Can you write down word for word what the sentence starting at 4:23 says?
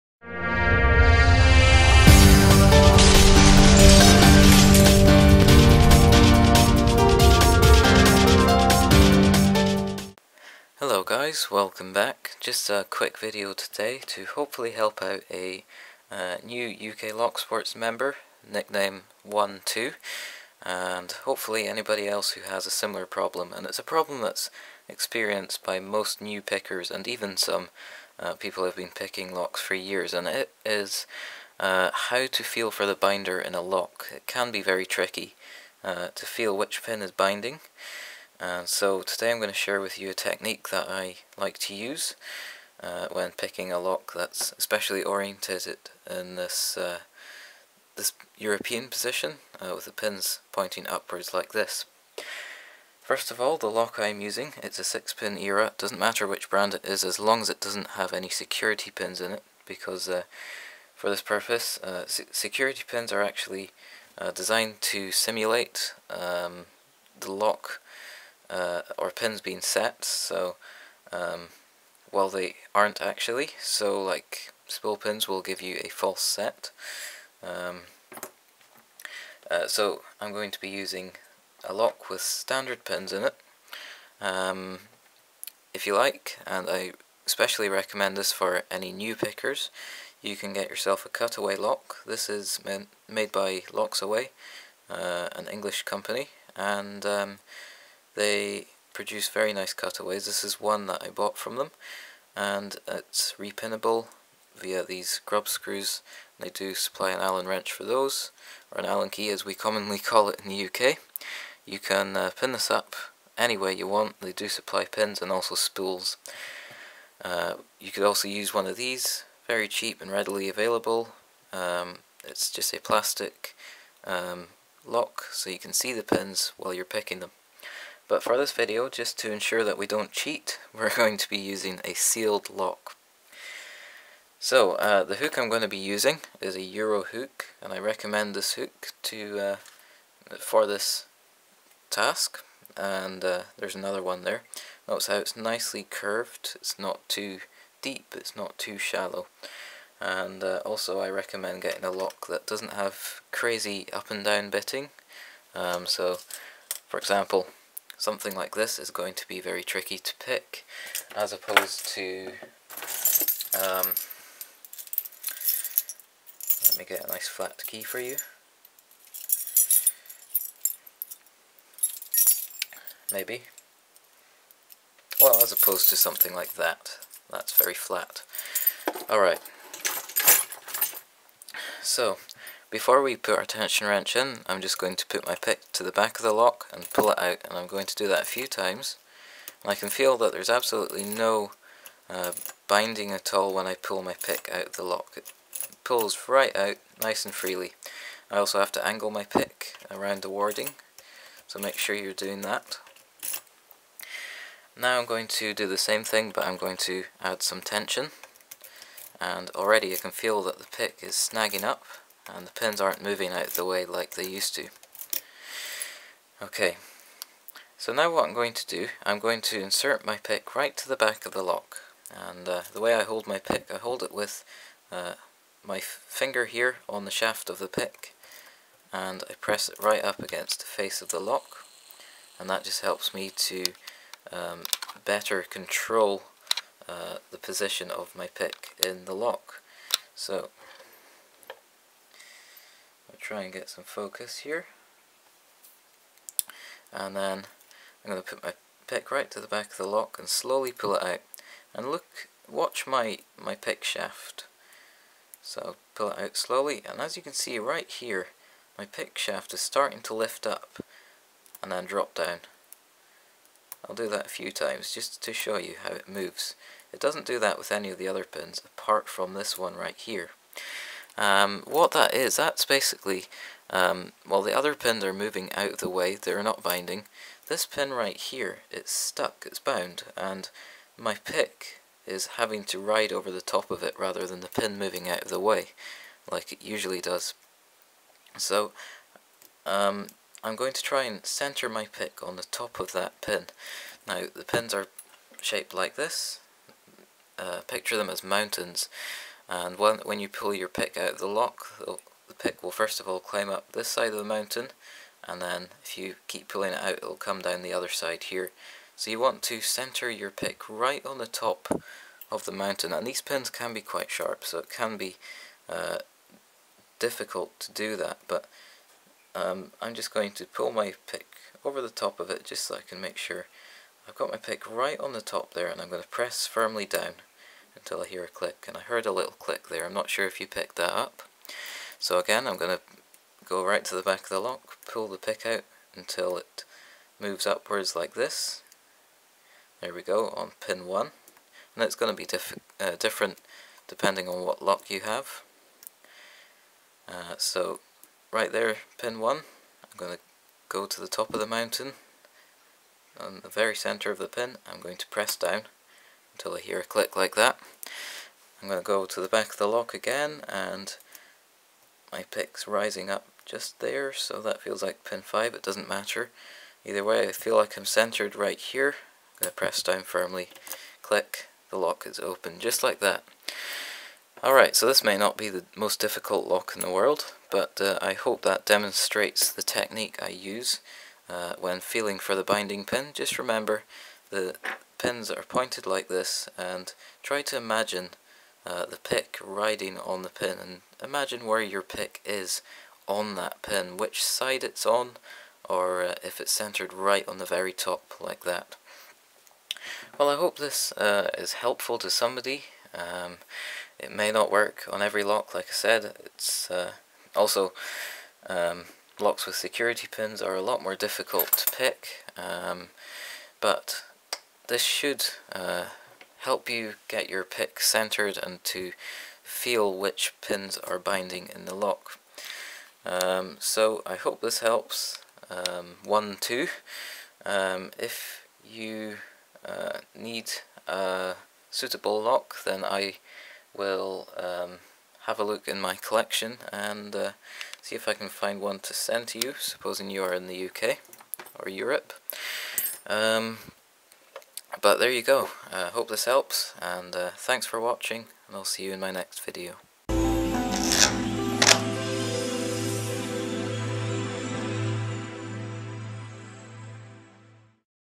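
I'll do that a few times just to show you how it moves.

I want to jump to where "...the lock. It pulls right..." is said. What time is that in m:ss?
3:14.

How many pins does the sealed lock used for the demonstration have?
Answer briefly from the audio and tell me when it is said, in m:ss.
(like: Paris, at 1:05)
6, at 0:55.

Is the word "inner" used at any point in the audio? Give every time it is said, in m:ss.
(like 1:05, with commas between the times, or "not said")
not said.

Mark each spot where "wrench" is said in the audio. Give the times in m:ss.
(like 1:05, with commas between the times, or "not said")
1:47, 3:03.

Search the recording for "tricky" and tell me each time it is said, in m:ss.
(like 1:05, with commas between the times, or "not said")
0:34, 2:39.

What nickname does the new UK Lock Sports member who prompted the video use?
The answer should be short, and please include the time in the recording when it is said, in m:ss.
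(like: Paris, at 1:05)
1-2, at 0:19.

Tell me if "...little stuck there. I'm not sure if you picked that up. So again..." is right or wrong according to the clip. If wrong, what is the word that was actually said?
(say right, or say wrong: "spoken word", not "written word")
wrong: "click", not "stuck".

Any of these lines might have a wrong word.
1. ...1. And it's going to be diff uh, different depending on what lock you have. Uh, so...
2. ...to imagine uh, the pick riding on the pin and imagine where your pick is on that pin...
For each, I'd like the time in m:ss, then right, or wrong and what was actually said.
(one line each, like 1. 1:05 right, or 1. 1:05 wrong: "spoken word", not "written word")
1. 5:40 right
2. 6:27 right.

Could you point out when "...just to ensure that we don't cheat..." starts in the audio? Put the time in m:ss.
2:08.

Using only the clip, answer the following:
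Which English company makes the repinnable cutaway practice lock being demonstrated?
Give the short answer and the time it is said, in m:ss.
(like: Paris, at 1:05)
Locksaway, at 1:33.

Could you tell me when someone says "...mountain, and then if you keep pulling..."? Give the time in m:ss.
5:04.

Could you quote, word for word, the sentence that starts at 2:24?
Notice how it's nicely curved, it's not too deep, it's not too shallow.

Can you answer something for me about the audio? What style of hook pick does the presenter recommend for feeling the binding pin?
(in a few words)
Euro hook.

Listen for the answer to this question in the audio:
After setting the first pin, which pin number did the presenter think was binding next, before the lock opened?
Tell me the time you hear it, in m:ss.
6:05.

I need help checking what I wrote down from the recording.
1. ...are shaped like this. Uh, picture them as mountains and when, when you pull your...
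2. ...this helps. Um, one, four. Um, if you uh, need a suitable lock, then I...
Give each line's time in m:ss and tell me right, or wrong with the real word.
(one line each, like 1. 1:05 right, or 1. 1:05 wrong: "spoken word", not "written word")
1. 4:54 right
2. 7:04 wrong: "two", not "four".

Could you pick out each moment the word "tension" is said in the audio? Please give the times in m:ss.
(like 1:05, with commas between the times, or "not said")
3:03, 3:27.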